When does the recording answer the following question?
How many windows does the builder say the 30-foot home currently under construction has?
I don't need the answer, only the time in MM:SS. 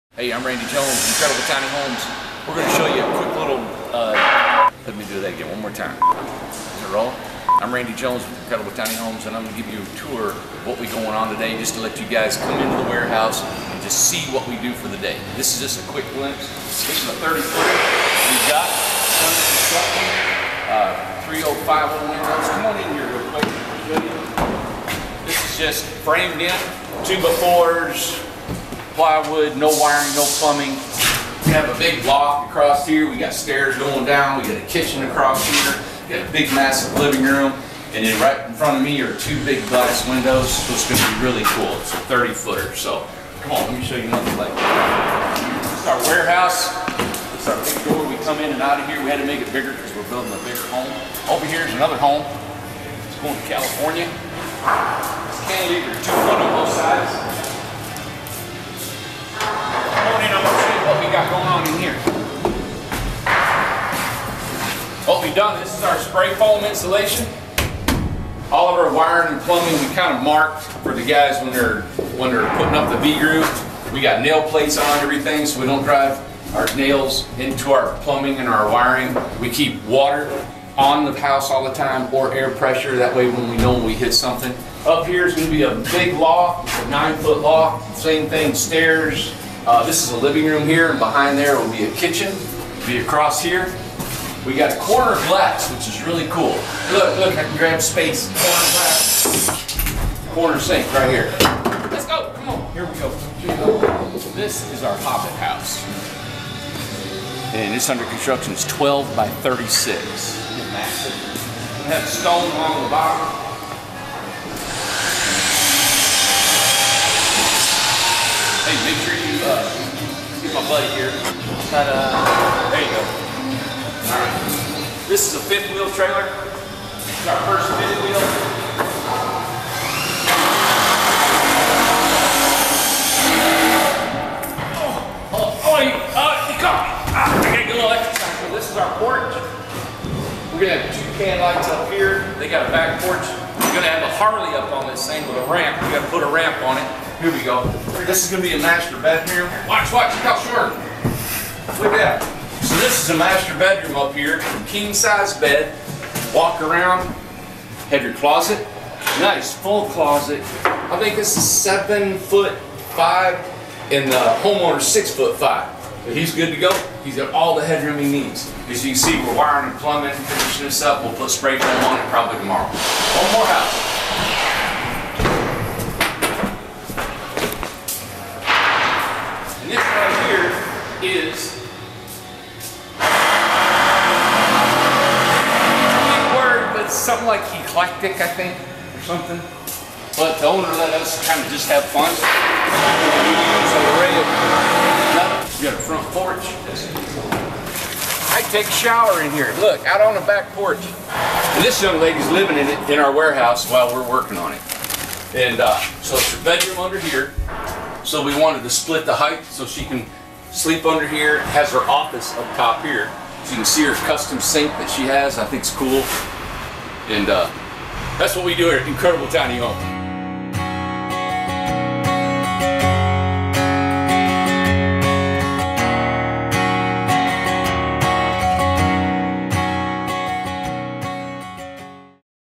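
00:21.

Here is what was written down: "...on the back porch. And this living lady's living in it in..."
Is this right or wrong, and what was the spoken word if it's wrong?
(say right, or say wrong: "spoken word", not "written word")
wrong: "young", not "living".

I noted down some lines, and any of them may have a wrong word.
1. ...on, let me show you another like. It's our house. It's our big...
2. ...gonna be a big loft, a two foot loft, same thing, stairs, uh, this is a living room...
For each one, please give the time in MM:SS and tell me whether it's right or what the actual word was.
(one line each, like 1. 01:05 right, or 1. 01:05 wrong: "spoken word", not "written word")
1. 00:43 wrong: "warehouse", not "house"
2. 01:25 wrong: "nine", not "two".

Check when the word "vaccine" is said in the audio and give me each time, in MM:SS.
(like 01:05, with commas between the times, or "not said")
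not said.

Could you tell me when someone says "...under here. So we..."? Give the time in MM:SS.
03:26.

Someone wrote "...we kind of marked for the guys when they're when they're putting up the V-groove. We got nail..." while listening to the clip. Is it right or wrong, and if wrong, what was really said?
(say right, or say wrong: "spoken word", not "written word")
right.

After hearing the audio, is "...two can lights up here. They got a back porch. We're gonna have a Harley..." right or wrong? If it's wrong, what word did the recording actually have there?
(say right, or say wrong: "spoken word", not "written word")
right.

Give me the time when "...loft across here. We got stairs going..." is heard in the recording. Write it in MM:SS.
00:32.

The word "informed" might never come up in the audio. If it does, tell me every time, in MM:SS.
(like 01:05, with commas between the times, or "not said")
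not said.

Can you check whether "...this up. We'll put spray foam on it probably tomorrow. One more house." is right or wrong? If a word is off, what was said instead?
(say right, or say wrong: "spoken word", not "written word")
right.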